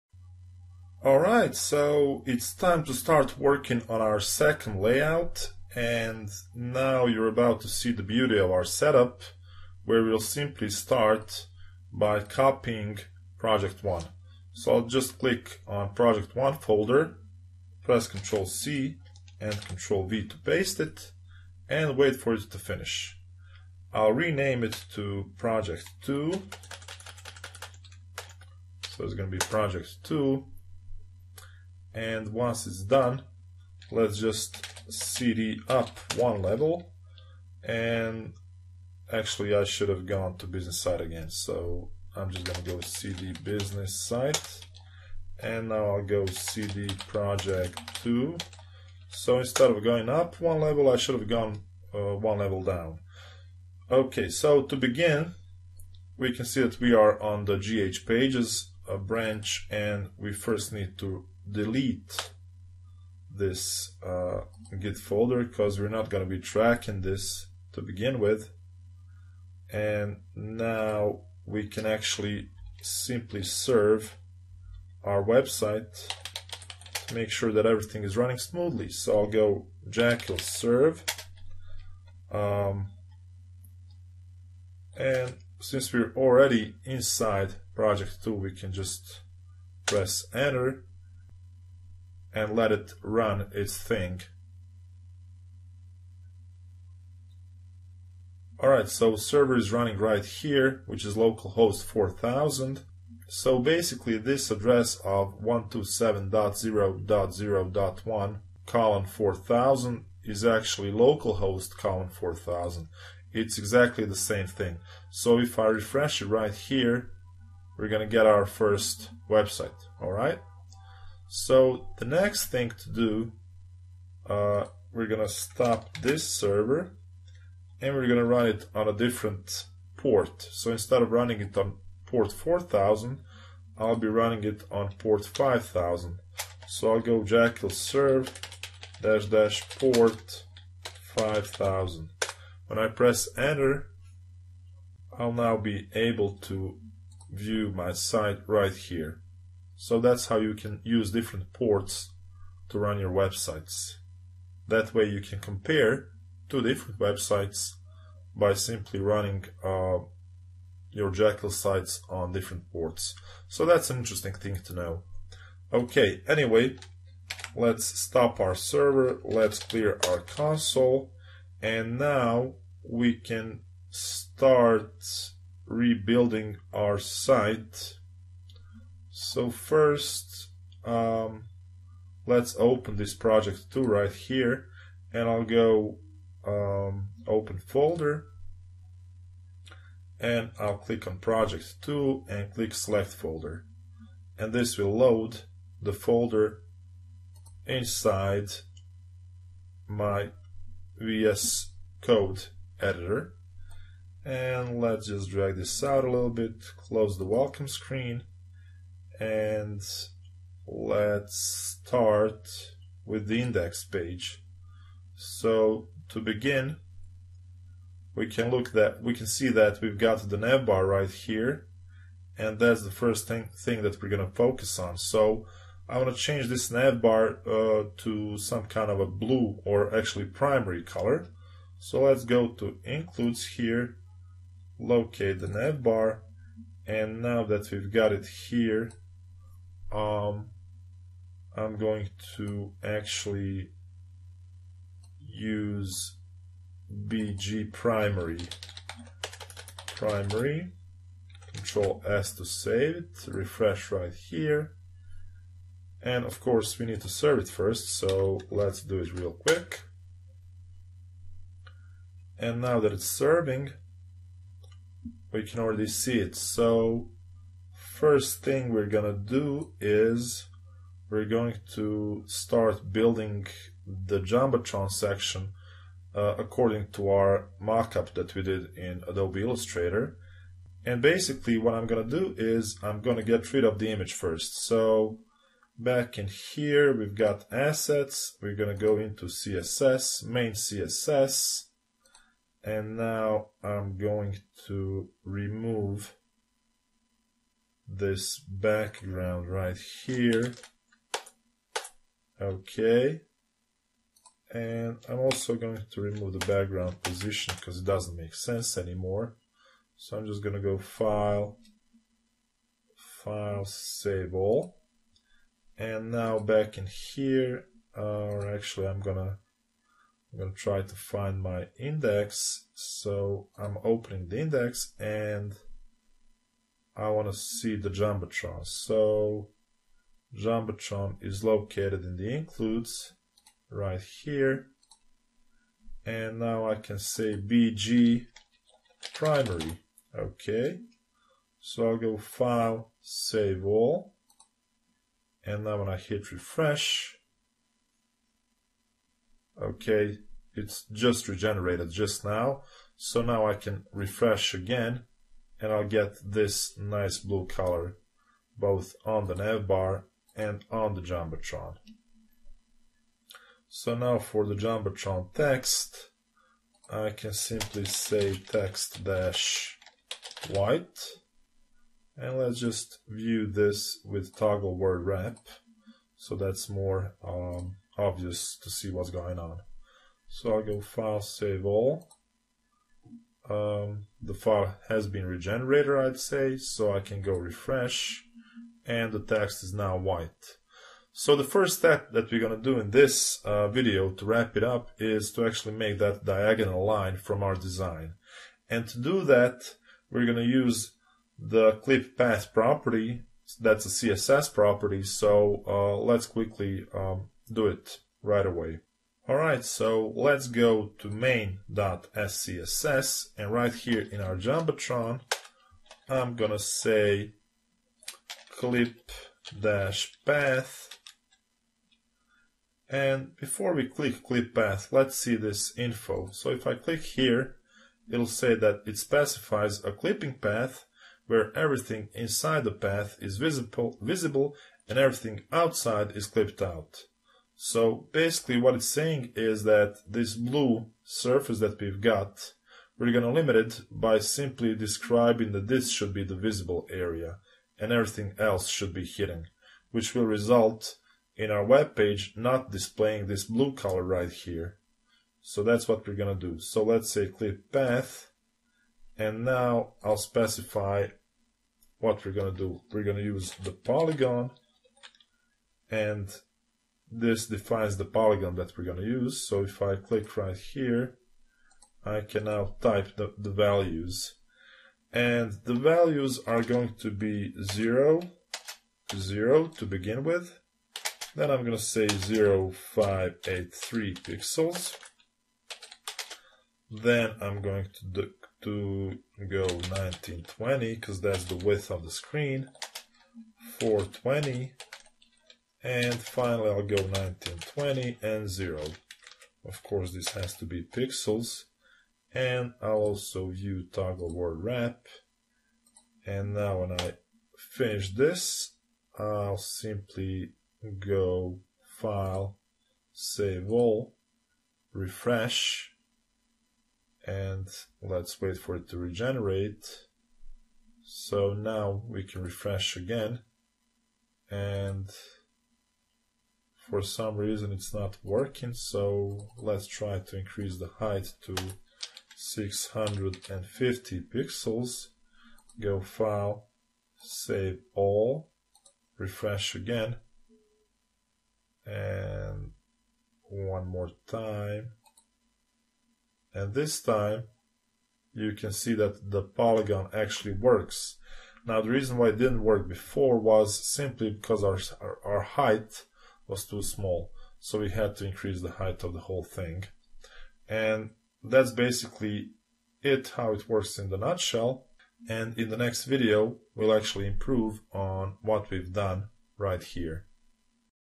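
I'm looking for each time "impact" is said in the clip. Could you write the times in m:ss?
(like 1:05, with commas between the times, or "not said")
not said.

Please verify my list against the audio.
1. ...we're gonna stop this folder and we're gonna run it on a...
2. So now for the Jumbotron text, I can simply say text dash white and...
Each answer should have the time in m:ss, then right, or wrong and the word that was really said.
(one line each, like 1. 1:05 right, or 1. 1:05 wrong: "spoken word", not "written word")
1. 2:04 wrong: "server", not "folder"
2. 6:03 right.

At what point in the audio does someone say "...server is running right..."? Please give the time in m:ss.
1:39.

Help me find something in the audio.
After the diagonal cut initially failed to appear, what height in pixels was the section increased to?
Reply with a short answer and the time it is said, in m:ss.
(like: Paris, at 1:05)
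650, at 8:52.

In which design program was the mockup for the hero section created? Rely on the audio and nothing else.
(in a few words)
Adobe Illustrator.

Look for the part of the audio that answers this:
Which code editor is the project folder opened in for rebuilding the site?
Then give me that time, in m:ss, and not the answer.
3:20.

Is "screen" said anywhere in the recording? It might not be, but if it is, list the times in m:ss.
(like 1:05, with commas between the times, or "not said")
3:27, 8:12.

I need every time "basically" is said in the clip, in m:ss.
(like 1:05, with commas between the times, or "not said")
1:43, 4:40, 7:18, 9:21.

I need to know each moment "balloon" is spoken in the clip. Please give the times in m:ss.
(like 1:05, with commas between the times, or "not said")
not said.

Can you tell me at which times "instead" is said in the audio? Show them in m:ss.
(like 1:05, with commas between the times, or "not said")
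0:49, 2:10.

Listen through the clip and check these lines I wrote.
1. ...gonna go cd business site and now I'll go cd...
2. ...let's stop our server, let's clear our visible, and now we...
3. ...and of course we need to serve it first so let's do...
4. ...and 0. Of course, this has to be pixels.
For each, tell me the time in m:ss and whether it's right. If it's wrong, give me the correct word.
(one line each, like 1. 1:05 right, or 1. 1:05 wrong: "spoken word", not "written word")
1. 0:42 right
2. 2:47 wrong: "console", not "visible"
3. 4:16 right
4. 8:18 right.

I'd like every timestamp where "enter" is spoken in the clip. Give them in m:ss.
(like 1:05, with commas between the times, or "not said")
1:30, 2:23.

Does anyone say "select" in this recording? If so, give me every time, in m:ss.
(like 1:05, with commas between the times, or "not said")
3:12.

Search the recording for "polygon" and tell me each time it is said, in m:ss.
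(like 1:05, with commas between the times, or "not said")
7:43, 7:48, 9:09.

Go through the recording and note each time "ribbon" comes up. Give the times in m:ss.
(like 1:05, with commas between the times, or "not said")
not said.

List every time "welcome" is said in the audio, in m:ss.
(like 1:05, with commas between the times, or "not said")
3:27.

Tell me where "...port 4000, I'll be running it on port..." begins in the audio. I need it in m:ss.
2:12.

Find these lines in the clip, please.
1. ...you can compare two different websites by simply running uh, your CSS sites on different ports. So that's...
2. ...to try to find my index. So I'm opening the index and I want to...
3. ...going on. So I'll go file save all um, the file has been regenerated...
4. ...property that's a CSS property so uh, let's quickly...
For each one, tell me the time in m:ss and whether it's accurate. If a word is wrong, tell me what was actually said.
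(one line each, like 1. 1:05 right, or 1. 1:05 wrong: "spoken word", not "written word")
1. 2:35 wrong: "Jekyll", not "CSS"
2. 5:20 right
3. 6:19 right
4. 6:42 right.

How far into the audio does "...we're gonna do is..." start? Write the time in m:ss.
4:28.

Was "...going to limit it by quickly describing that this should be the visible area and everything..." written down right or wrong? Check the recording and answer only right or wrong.
wrong.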